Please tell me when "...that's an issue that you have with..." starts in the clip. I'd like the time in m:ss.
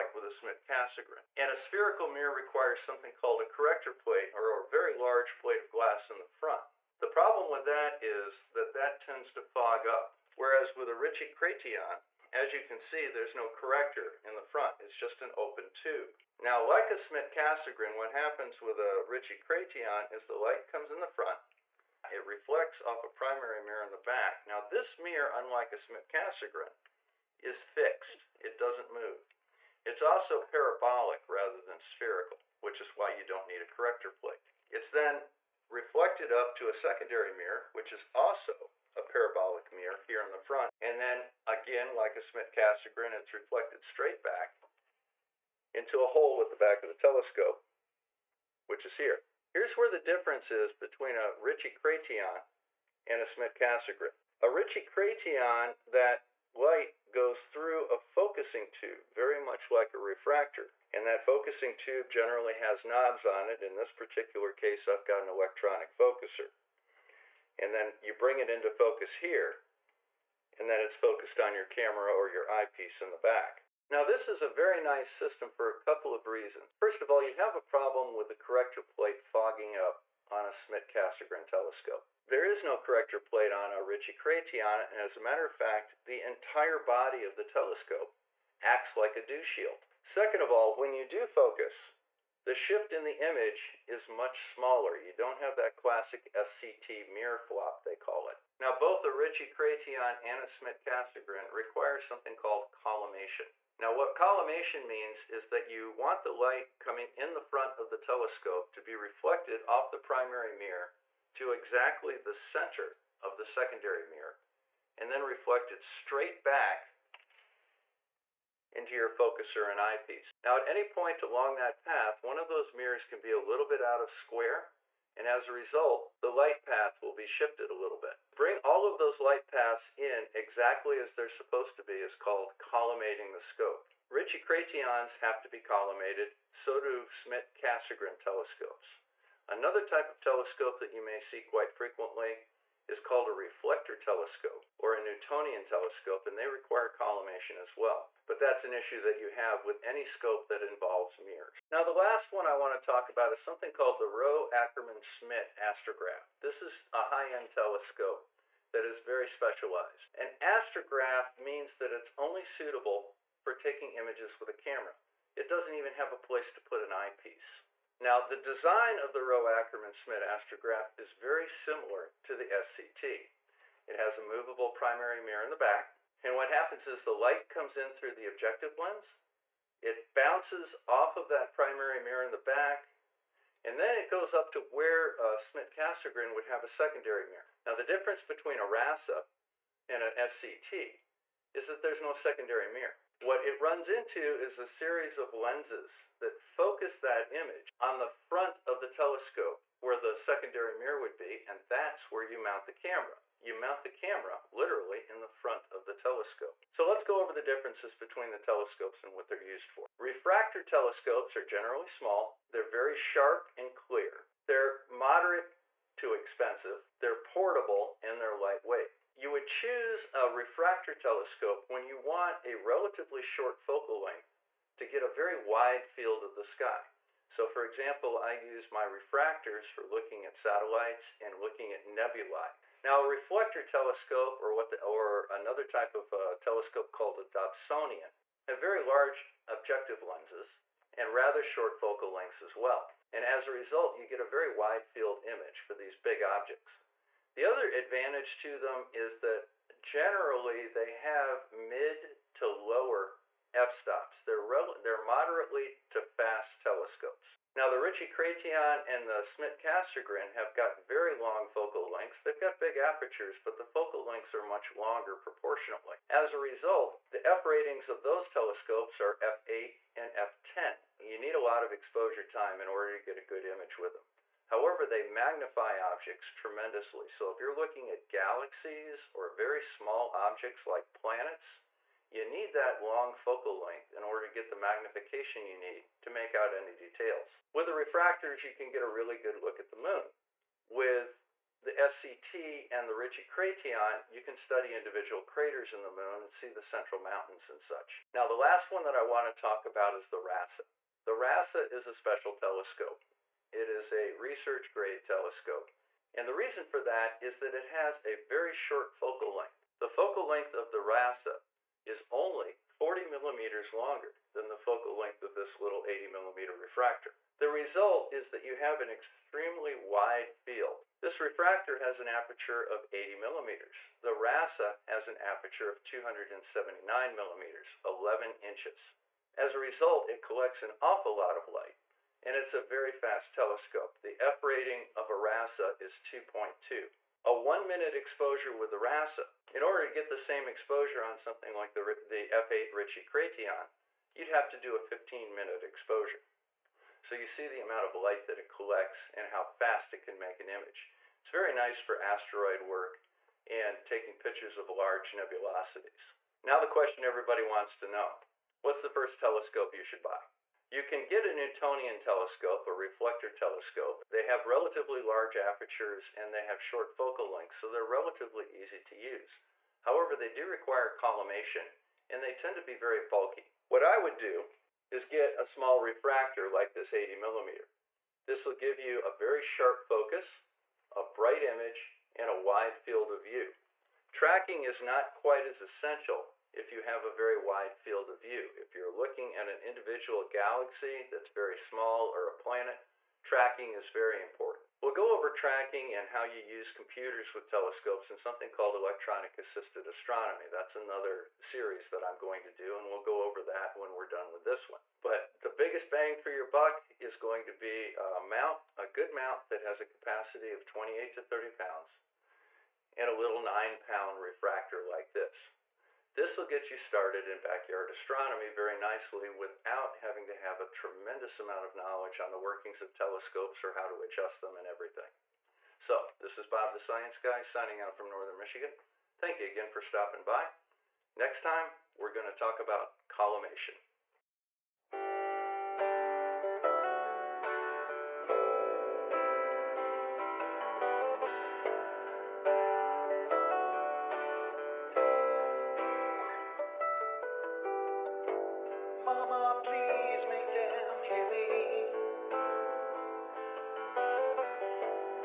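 2:28.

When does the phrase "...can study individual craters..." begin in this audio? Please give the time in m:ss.
4:54.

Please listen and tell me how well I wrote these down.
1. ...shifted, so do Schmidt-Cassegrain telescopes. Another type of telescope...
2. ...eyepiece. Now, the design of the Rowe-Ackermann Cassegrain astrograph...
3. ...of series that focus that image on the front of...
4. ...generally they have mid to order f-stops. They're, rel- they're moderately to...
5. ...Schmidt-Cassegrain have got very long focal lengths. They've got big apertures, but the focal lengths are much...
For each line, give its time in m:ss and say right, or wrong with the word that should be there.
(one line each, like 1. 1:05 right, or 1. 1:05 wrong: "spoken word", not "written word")
1. 2:15 wrong: "collimated", not "shifted"
2. 2:46 wrong: "Schmidt", not "Cassegrain"
3. 3:15 wrong: "lenses", not "series"
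4. 4:09 wrong: "lower", not "order"
5. 4:19 right.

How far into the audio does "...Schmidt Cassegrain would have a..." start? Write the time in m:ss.
3:05.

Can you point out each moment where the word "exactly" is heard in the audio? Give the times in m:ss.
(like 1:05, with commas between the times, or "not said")
1:51, 2:10.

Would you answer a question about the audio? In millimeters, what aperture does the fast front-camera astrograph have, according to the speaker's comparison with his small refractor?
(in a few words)
279 millimeters.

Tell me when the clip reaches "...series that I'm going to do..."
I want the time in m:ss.
6:41.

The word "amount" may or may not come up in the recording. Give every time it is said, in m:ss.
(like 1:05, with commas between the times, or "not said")
5:47, 7:01.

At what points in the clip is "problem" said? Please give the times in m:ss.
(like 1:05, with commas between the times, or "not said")
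0:07, 1:17.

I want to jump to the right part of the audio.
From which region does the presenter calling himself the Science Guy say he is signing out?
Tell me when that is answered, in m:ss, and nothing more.
7:08.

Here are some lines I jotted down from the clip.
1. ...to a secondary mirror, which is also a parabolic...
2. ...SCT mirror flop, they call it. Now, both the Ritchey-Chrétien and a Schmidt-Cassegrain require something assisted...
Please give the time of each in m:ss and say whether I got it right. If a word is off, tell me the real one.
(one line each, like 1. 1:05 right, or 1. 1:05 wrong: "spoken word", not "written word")
1. 0:36 right
2. 1:36 wrong: "called", not "assisted".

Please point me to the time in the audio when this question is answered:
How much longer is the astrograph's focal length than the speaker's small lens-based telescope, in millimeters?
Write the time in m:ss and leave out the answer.
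5:12.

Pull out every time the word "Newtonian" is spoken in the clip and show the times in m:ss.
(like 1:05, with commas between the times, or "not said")
2:24, 6:01.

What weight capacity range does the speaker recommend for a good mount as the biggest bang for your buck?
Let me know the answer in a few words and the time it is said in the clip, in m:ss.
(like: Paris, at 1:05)
28 to 30 pounds, at 6:50.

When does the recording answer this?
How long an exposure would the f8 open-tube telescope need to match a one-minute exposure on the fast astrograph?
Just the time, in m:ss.
5:44.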